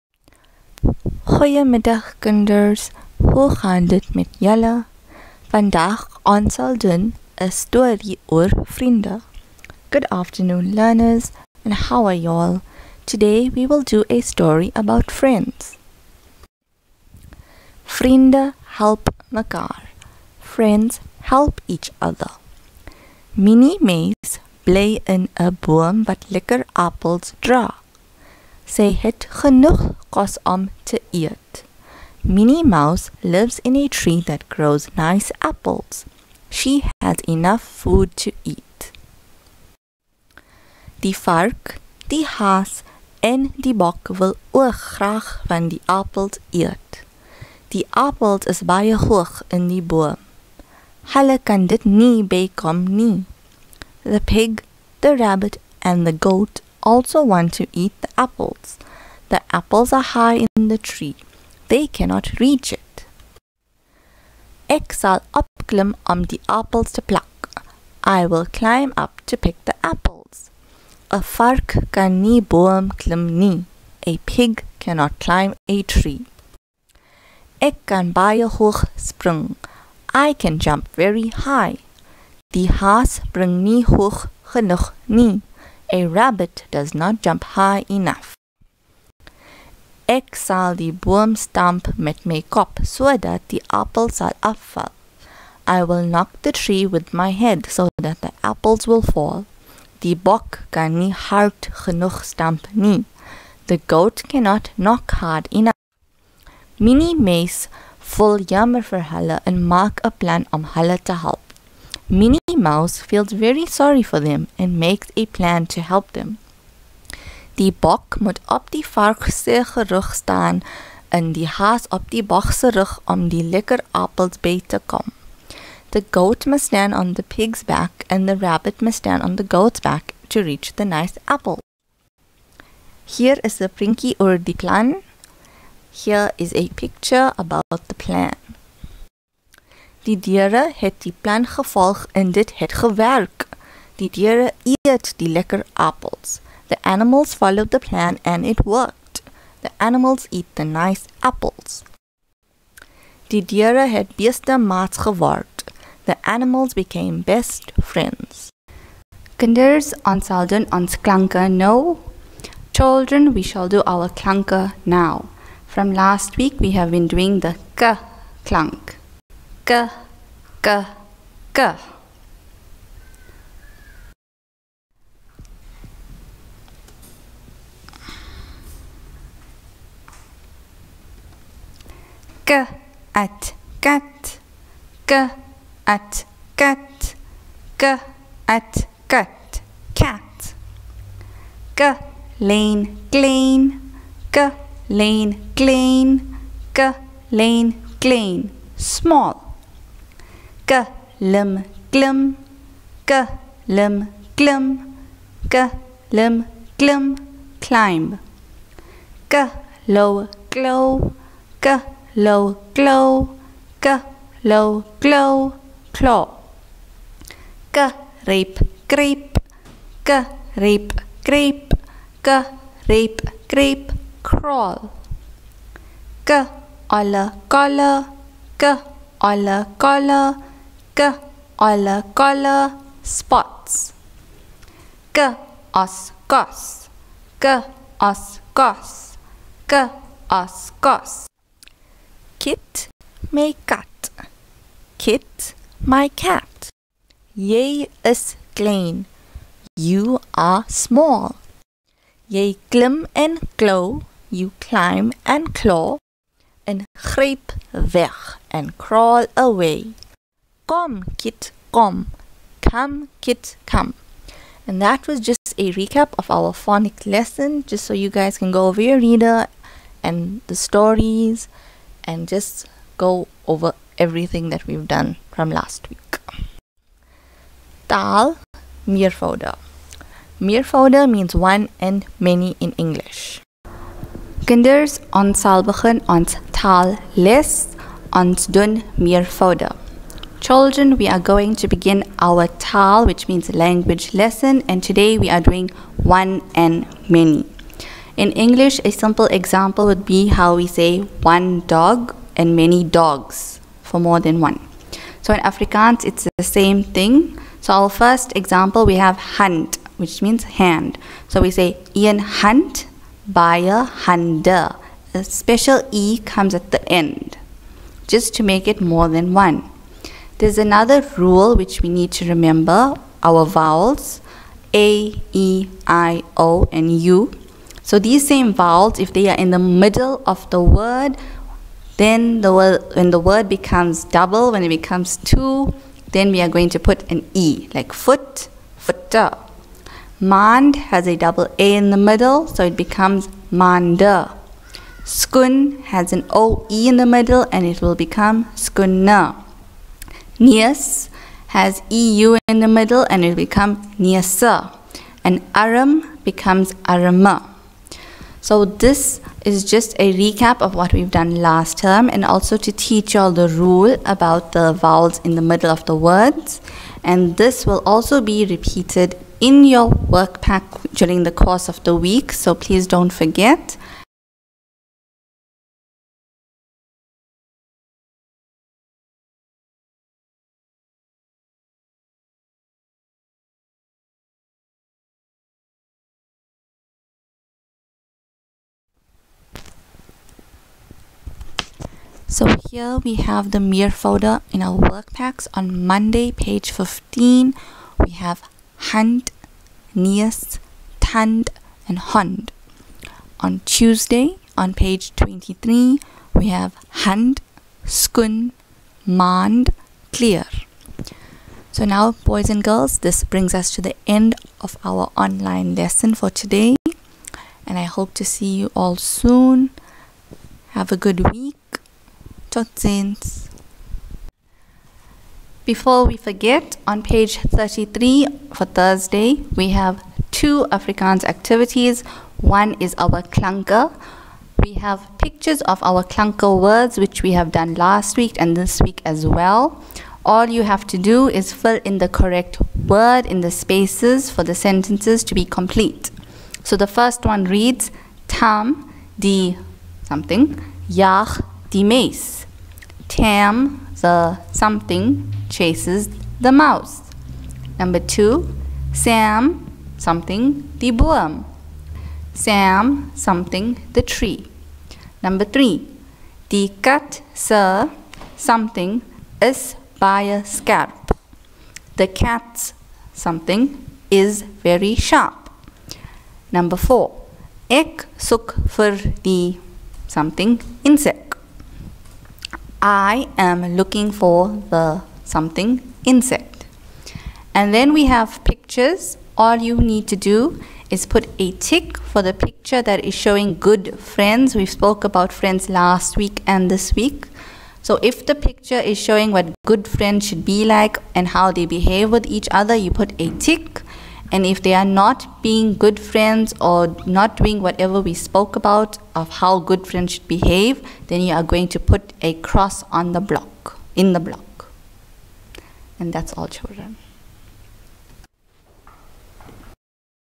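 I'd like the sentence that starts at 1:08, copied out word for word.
I will climb up to pick the apples.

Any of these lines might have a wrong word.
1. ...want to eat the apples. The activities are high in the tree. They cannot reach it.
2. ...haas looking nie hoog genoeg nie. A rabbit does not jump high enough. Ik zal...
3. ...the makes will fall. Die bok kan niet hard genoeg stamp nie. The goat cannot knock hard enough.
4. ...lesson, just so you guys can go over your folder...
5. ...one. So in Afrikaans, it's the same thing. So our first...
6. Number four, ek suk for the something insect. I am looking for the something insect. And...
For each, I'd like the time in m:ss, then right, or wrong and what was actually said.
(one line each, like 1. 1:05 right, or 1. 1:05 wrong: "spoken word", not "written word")
1. 0:57 wrong: "apples", not "activities"
2. 1:22 wrong: "spring", not "looking"
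3. 1:38 wrong: "apples", not "makes"
4. 4:27 wrong: "reader", not "folder"
5. 5:04 right
6. 7:56 right.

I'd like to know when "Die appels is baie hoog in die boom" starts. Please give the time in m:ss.
0:47.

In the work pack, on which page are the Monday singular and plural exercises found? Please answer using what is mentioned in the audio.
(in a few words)
15.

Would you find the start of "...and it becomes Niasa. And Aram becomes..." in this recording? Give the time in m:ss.
5:53.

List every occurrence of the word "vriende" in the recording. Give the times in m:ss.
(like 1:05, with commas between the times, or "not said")
0:08, 0:17.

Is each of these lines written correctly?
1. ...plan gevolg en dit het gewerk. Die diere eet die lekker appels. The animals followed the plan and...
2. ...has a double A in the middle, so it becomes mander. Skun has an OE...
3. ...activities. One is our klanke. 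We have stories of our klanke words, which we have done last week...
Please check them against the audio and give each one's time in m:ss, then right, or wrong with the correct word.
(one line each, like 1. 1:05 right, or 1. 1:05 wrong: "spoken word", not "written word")
1. 2:21 right
2. 5:40 right
3. 7:11 wrong: "pictures", not "stories".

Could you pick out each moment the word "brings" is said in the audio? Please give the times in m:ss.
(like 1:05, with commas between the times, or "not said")
6:53.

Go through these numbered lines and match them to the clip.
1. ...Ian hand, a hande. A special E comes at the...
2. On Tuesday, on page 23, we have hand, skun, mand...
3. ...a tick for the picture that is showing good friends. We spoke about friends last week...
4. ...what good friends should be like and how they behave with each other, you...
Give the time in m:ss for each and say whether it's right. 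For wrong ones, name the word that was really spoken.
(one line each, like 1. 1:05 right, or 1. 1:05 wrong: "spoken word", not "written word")
1. 5:11 right
2. 6:43 right
3. 8:11 right
4. 8:19 right.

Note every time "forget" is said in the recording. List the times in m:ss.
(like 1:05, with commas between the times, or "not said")
6:13, 7:06.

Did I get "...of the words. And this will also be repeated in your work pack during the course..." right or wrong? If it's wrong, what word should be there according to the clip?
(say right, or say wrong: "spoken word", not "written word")
right.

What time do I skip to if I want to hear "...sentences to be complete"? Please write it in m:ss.
7:24.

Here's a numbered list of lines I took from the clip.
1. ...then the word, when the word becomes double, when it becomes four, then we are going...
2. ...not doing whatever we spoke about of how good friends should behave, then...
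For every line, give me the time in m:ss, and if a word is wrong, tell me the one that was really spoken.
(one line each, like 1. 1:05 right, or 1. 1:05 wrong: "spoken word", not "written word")
1. 5:31 wrong: "two", not "four"
2. 8:27 right.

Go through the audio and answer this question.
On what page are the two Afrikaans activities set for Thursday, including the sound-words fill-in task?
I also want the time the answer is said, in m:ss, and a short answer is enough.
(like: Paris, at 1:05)
33, at 7:07.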